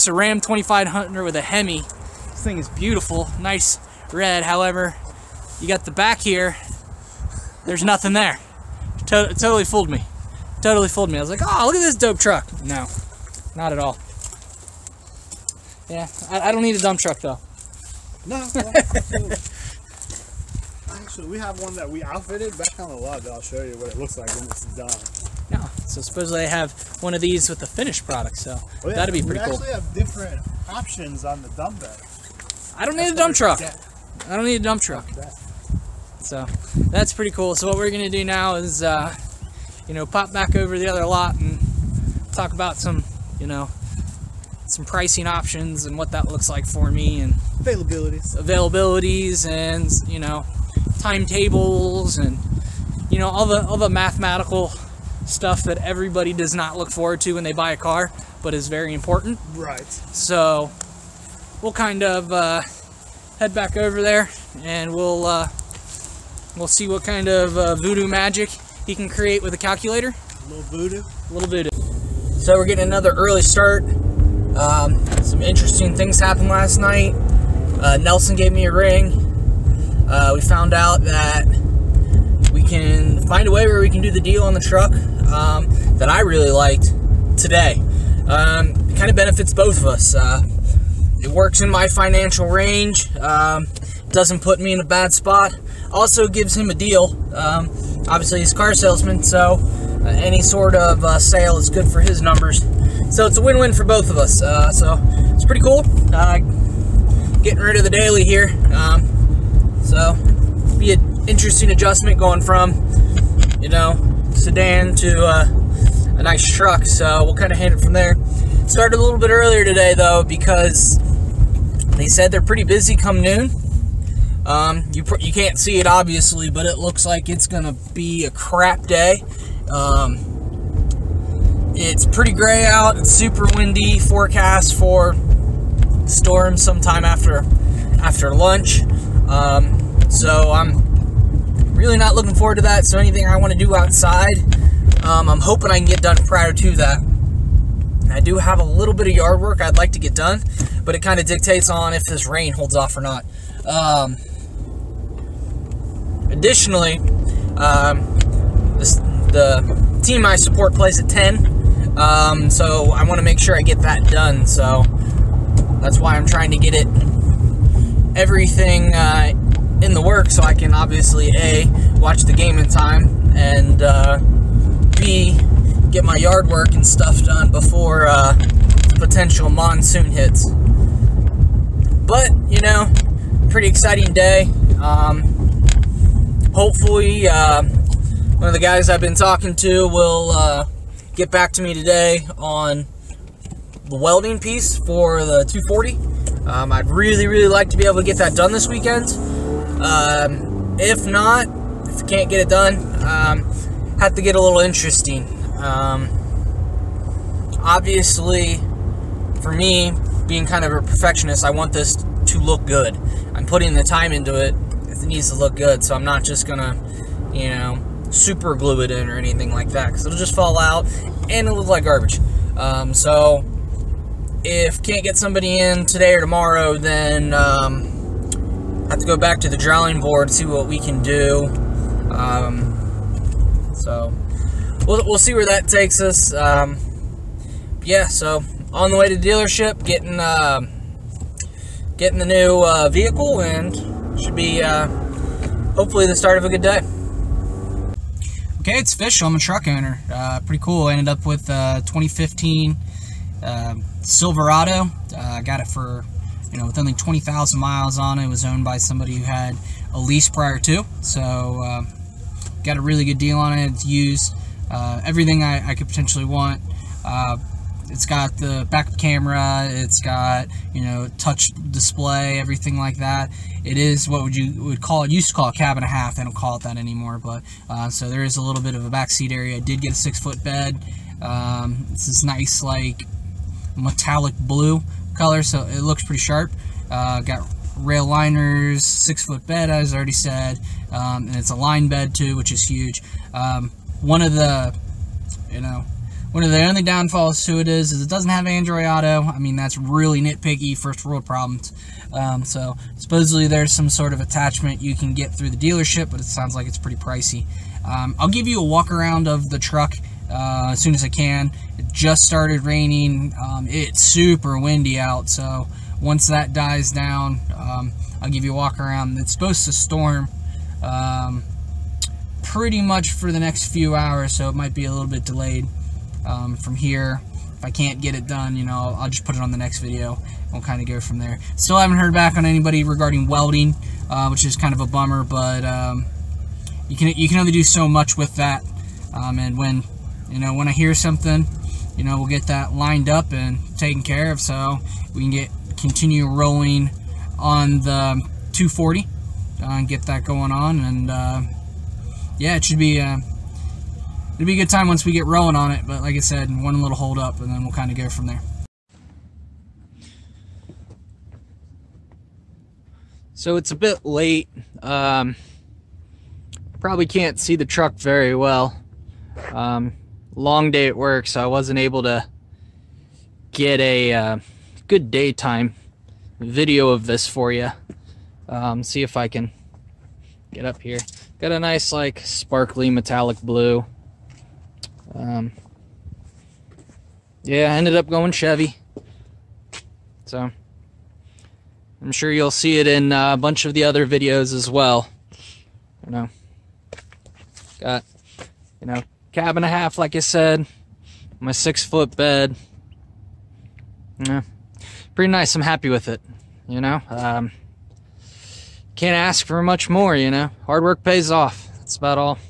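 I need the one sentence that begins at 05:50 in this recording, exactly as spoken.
And uh, yeah, it should be.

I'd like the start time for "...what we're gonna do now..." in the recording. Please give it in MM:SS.
00:37.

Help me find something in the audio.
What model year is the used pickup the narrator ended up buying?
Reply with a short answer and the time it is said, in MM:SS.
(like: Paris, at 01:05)
2015, at 04:11.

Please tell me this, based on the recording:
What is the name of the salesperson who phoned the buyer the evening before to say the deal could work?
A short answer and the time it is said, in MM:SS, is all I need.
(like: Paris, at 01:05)
Nelson, at 01:17.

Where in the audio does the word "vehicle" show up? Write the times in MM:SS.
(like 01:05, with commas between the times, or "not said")
04:02.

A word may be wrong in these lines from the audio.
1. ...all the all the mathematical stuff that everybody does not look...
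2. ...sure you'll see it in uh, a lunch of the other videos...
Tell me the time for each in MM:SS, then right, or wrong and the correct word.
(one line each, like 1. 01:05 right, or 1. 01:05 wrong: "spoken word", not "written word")
1. 00:53 right
2. 06:32 wrong: "bunch", not "lunch".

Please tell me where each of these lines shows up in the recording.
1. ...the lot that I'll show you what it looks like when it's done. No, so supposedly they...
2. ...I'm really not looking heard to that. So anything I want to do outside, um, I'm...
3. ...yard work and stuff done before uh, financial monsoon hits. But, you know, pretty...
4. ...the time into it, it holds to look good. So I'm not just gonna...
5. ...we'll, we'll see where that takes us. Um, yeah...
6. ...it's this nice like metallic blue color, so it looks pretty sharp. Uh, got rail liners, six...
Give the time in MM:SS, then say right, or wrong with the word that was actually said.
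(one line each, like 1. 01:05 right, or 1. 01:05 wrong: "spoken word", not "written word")
1. 00:22 right
2. 02:20 wrong: "forward", not "heard"
3. 02:56 wrong: "potential", not "financial"
4. 03:33 wrong: "needs", not "holds"
5. 03:54 right
6. 04:41 right.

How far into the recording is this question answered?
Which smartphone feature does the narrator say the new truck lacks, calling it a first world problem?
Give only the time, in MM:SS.
04:58.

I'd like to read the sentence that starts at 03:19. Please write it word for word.
Um, if not, if I can't get it done, um, have to get a little interesting.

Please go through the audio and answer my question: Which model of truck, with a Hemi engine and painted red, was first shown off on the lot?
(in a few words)
Ram 2500.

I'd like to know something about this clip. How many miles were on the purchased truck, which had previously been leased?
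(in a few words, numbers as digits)
20,000.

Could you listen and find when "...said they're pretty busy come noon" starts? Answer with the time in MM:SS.
02:02.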